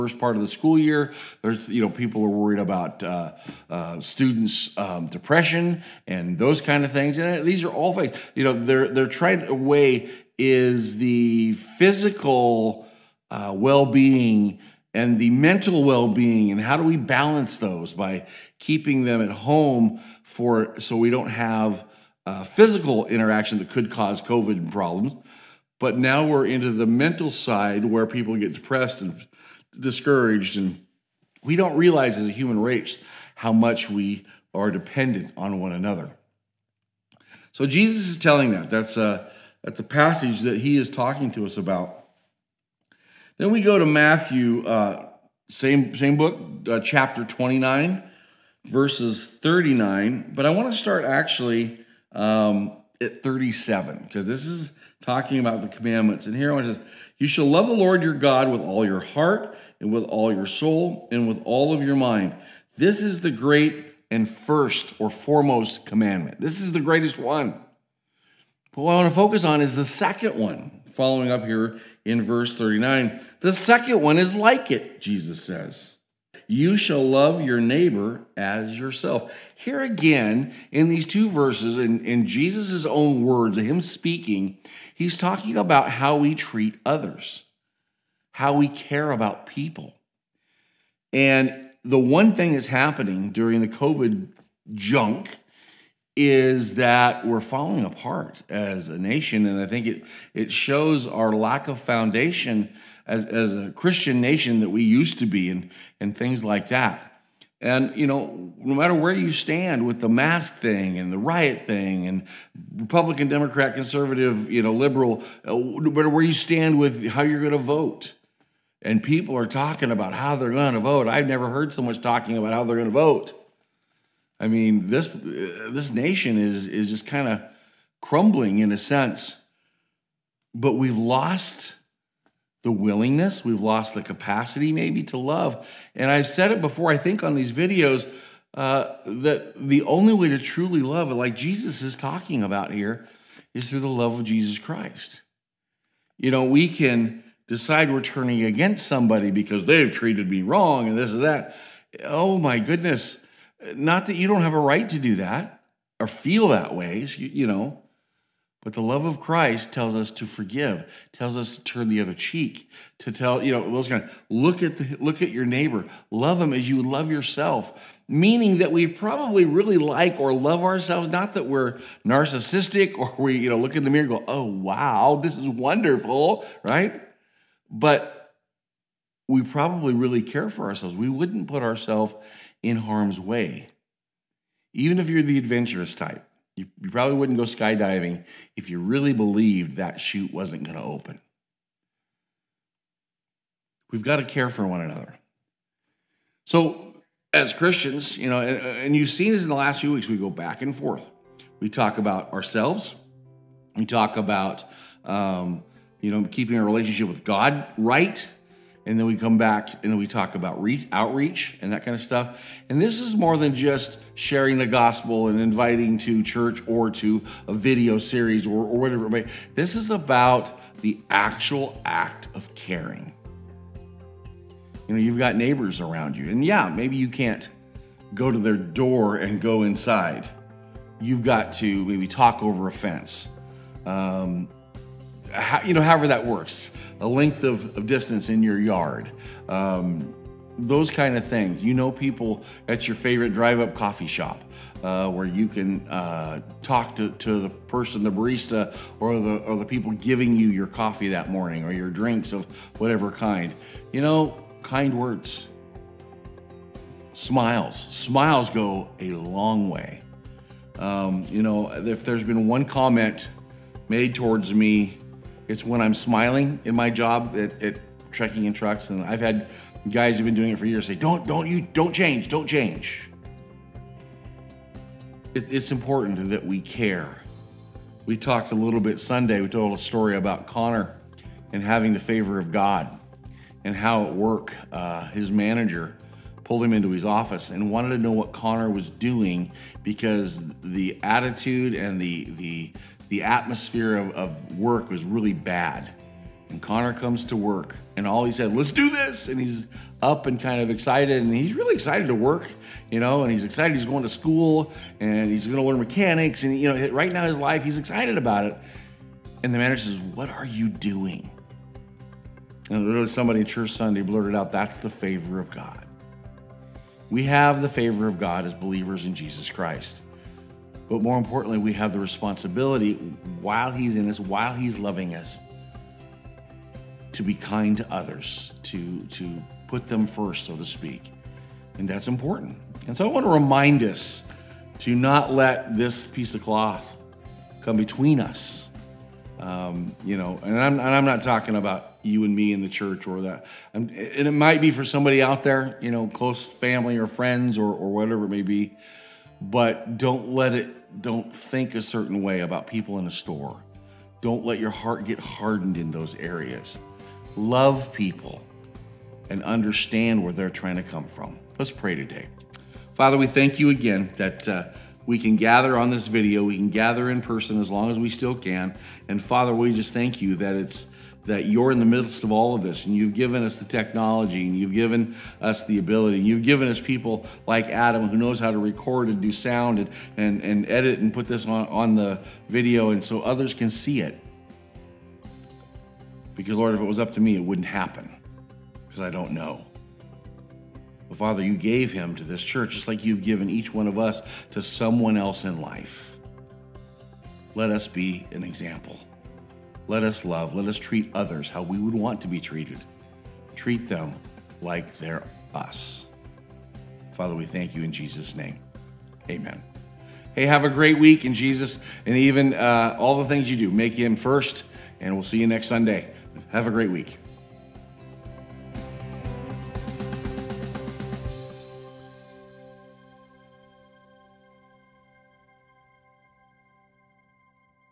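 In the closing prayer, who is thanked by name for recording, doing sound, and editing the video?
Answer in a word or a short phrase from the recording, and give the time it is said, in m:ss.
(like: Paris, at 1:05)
Adam, at 6:17.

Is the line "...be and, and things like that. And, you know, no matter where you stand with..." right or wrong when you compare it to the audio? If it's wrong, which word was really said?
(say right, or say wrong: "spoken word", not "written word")
right.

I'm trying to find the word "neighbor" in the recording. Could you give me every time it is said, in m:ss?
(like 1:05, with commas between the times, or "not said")
1:17, 2:45, 3:45.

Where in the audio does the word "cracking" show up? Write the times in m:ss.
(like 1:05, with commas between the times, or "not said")
not said.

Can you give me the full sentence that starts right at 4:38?
We talked a little bit Sunday.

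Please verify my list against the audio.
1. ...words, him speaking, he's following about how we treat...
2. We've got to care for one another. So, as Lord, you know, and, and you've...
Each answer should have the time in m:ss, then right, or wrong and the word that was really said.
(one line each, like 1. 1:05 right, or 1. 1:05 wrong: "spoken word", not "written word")
1. 1:23 wrong: "talking", not "following"
2. 3:13 wrong: "Christians", not "Lord".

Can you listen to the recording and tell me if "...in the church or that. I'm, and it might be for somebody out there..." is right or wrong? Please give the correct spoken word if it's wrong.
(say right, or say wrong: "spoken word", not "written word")
right.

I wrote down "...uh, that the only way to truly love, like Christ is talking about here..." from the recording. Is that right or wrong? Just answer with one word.
wrong.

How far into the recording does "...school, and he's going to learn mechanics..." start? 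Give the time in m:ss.
5:04.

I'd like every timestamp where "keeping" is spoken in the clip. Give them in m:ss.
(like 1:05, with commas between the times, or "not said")
0:18, 3:26.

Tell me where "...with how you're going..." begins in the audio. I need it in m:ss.
1:56.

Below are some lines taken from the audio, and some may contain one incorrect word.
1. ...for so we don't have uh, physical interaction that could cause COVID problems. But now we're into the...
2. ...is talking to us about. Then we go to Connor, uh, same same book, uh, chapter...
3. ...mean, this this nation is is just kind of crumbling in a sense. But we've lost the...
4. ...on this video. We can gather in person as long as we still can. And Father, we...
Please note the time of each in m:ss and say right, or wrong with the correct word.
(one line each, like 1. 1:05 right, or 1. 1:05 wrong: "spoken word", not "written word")
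1. 0:20 right
2. 0:40 wrong: "Matthew", not "Connor"
3. 2:04 right
4. 6:05 right.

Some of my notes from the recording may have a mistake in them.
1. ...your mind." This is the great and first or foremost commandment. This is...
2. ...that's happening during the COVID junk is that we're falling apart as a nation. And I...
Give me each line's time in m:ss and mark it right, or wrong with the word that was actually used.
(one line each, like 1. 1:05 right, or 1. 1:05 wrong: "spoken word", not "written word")
1. 1:01 right
2. 1:32 right.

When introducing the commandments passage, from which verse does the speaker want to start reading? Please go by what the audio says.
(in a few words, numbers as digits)
37.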